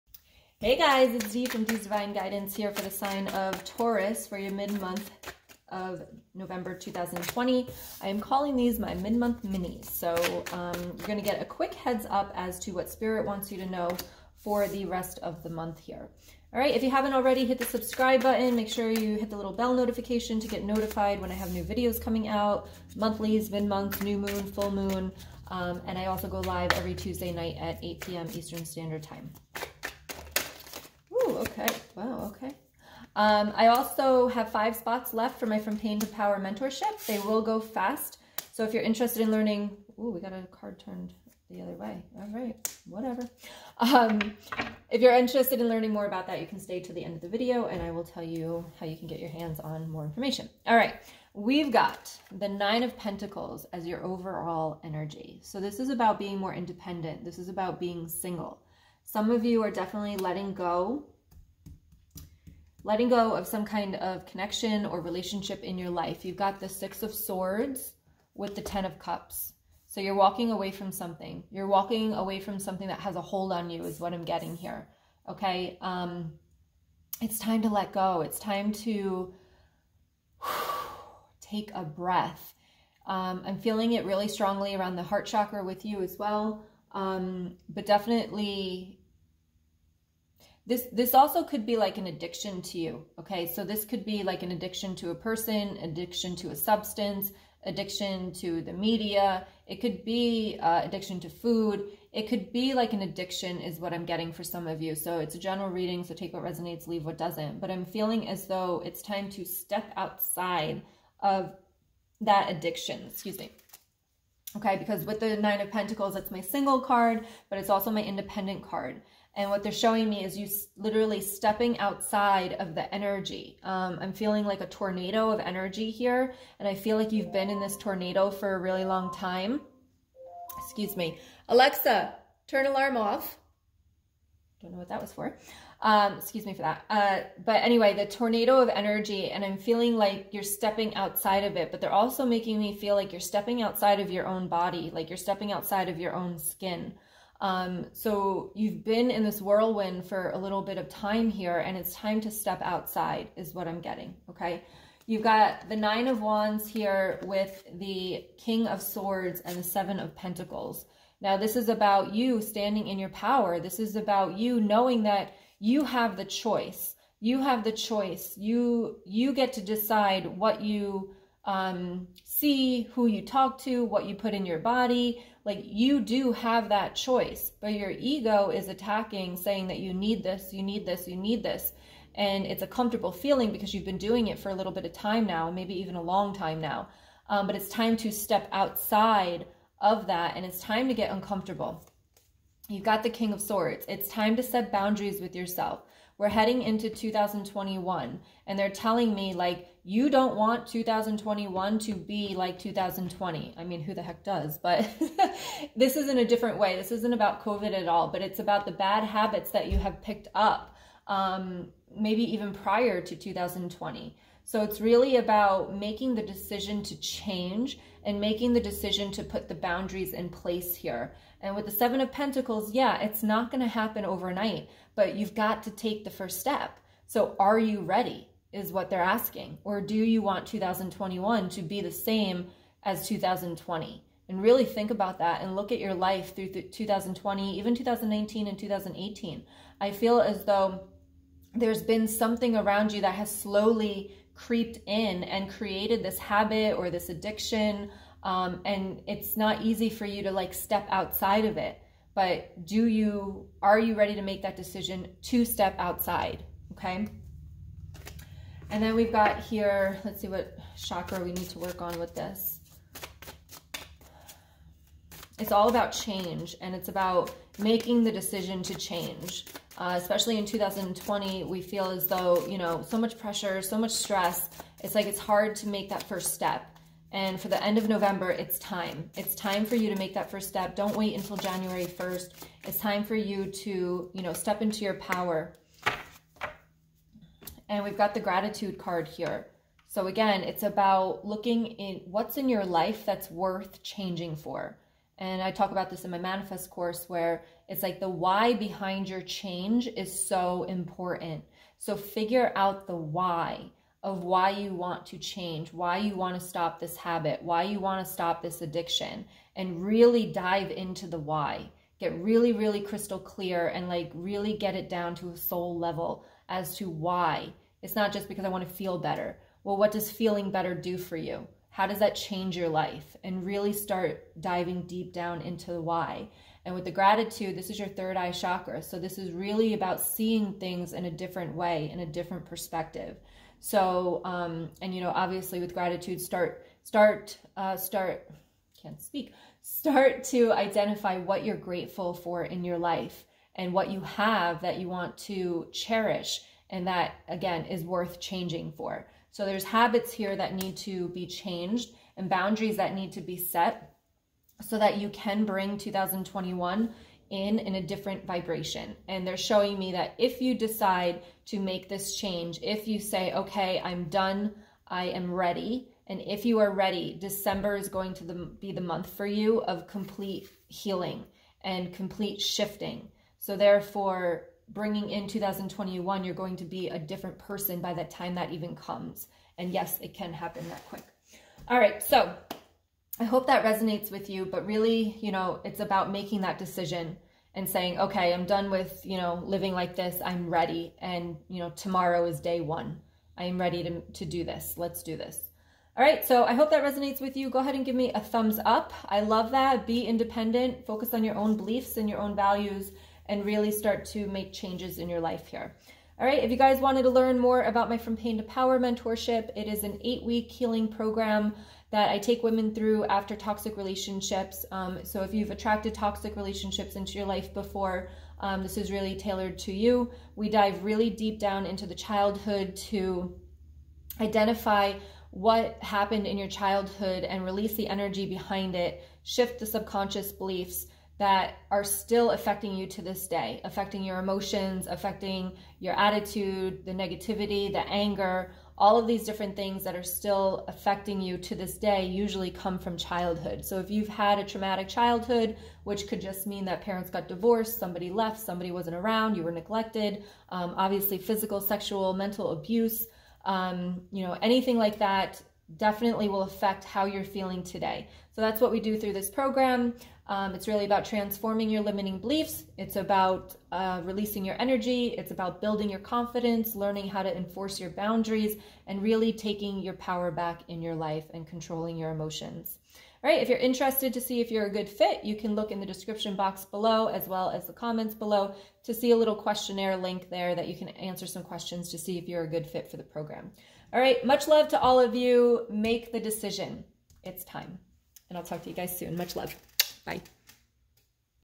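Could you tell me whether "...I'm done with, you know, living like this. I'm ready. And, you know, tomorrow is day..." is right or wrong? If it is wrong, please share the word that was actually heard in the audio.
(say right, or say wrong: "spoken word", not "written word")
right.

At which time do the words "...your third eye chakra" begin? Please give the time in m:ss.
5:27.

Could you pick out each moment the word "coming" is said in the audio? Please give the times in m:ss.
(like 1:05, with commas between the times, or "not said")
0:21.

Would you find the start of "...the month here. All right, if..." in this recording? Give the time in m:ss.
0:15.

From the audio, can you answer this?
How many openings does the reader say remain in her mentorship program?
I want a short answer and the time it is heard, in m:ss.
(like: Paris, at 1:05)
5, at 0:34.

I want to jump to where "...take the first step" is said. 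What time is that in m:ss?
3:45.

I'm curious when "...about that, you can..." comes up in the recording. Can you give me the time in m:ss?
0:46.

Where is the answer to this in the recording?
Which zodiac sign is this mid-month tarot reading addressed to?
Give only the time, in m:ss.
0:03.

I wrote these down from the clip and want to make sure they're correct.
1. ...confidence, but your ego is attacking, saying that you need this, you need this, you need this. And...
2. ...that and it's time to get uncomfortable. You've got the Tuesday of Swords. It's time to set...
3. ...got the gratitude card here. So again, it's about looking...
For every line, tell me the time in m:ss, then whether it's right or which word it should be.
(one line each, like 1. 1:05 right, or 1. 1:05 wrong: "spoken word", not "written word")
1. 2:56 wrong: "choice", not "confidence"
2. 3:10 wrong: "King", not "Tuesday"
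3. 4:47 right.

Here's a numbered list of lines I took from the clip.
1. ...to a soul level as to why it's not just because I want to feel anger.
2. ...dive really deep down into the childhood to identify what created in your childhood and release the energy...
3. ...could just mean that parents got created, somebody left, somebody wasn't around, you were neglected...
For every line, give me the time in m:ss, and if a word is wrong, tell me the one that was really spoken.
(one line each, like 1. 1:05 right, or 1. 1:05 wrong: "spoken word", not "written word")
1. 5:15 wrong: "better", not "anger"
2. 7:00 wrong: "happened", not "created"
3. 7:26 wrong: "divorced", not "created".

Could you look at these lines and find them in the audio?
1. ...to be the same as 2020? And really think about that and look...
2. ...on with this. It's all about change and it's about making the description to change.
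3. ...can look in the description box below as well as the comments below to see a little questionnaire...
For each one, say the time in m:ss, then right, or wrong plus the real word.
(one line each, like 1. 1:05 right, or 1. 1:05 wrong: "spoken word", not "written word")
1. 3:51 right
2. 4:21 wrong: "decision", not "description"
3. 7:55 right.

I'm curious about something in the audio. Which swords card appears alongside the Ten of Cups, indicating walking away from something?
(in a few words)
Six of Swords.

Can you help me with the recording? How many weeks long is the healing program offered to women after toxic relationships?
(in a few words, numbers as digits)
8.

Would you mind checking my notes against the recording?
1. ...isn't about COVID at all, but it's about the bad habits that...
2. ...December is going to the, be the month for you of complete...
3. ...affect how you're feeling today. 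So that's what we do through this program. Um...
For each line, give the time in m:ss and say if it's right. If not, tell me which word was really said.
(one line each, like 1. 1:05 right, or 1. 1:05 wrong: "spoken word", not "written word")
1. 3:26 right
2. 6:07 right
3. 7:36 right.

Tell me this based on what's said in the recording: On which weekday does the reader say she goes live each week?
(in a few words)
Tuesday.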